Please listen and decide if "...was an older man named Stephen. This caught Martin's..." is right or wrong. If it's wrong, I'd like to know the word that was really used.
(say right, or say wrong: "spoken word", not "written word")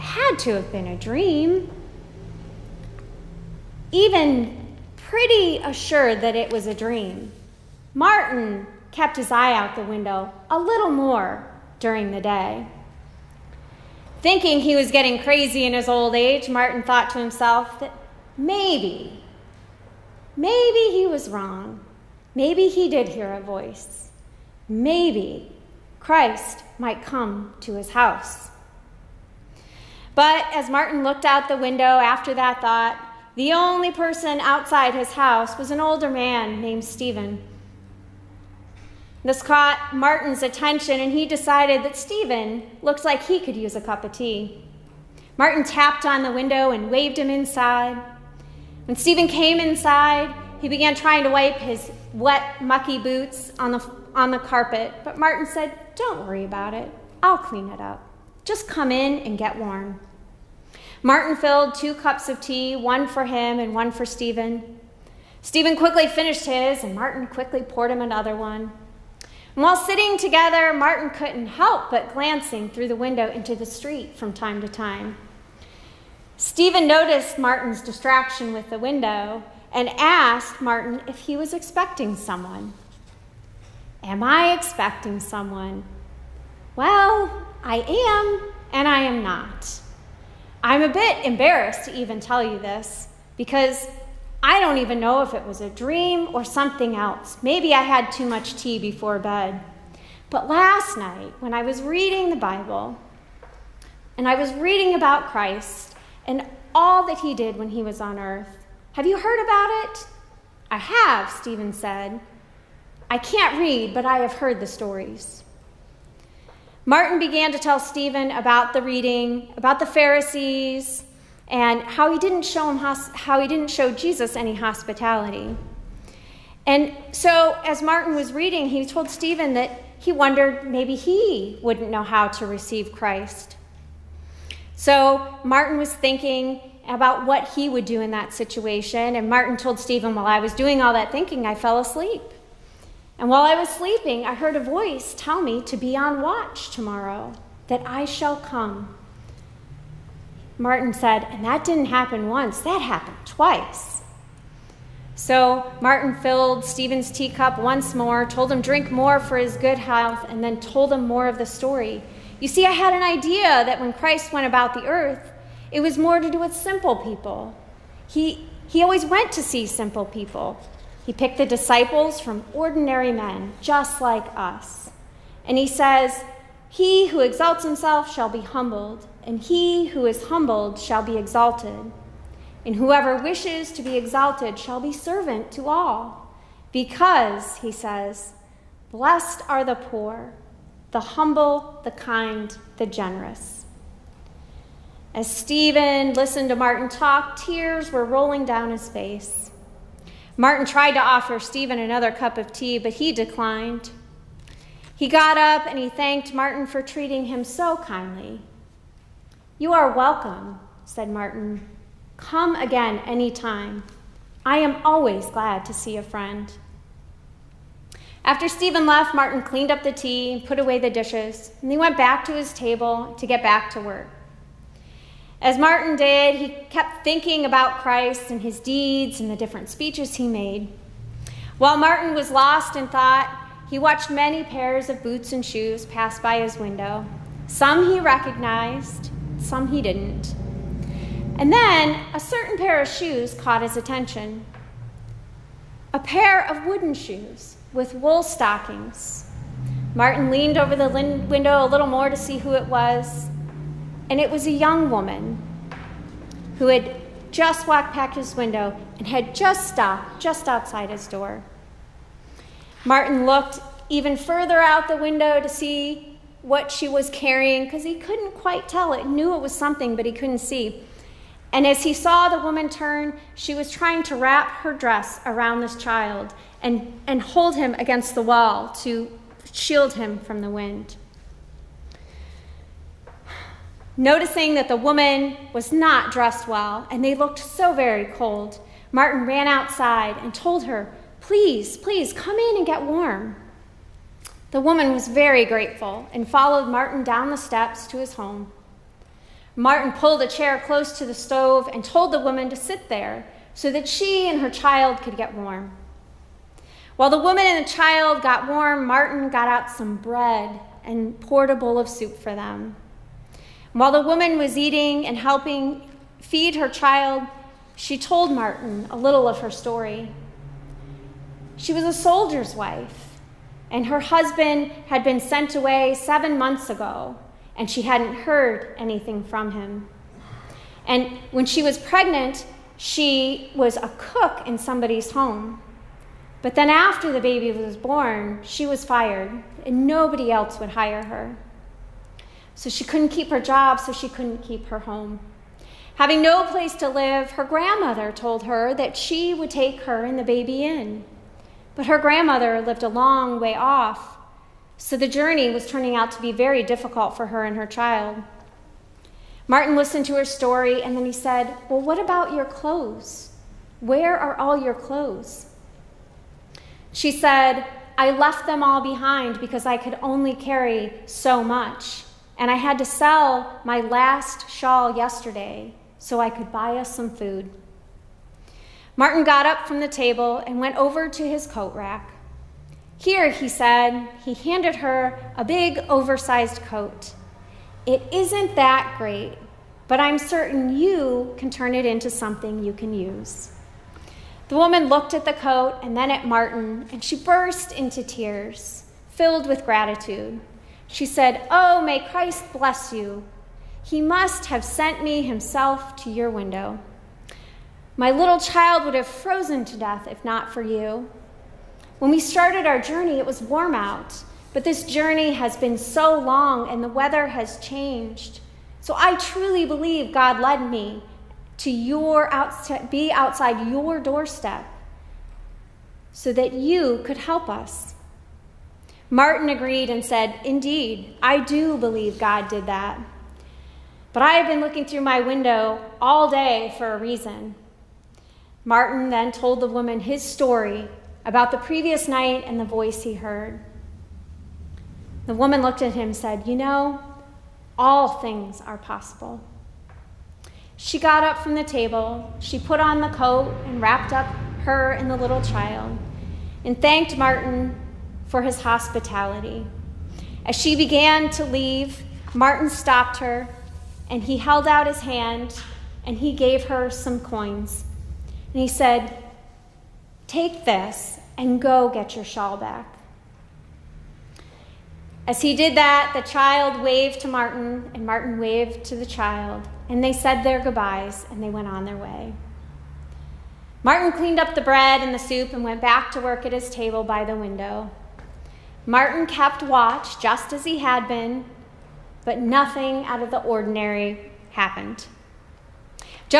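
right.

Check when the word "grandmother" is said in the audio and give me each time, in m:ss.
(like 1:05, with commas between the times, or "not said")
5:47, 5:51.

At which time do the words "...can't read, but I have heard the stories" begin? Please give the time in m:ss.
1:53.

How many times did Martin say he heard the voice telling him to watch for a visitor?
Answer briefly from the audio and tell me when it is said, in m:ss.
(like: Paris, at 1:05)
Twice, at 2:33.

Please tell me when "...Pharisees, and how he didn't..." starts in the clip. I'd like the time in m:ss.
1:59.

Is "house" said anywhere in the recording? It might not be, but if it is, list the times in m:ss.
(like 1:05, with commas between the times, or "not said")
0:27, 0:35.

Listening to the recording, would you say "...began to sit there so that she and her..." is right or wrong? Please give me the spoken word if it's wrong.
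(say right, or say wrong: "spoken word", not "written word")
wrong: "woman", not "began".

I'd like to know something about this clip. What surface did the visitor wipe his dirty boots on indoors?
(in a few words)
The carpet.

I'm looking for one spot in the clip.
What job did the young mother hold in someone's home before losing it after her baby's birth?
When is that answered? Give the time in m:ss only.
5:33.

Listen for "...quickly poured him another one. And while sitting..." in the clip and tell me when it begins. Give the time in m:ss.
1:07.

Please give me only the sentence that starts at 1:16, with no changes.
Stephen noticed Martin's distraction with the window and asked Martin if he was expecting someone.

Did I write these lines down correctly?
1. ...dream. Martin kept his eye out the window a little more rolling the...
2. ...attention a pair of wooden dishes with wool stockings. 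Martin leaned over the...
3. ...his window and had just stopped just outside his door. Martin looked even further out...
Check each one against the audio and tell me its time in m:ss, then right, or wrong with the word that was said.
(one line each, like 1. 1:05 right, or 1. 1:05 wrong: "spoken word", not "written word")
1. 0:06 wrong: "during", not "rolling"
2. 4:03 wrong: "shoes", not "dishes"
3. 4:18 right.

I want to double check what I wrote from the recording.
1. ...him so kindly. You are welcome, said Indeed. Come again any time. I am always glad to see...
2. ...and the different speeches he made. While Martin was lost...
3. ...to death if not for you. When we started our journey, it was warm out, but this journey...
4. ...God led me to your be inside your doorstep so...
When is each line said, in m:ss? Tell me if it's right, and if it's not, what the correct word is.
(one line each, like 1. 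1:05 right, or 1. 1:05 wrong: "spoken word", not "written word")
1. 3:27 wrong: "Martin", not "Indeed"
2. 3:49 right
3. 6:49 right
4. 7:00 wrong: "outside", not "inside".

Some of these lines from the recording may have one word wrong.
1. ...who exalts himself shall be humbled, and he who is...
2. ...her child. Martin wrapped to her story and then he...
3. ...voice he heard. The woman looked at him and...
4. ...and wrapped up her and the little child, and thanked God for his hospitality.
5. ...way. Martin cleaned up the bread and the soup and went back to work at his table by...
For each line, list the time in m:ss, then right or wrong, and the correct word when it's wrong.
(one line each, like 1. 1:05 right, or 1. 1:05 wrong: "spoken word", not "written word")
1. 2:57 right
2. 5:57 wrong: "listened", not "wrapped"
3. 7:22 right
4. 7:33 wrong: "Martin", not "God"
5. 8:01 right.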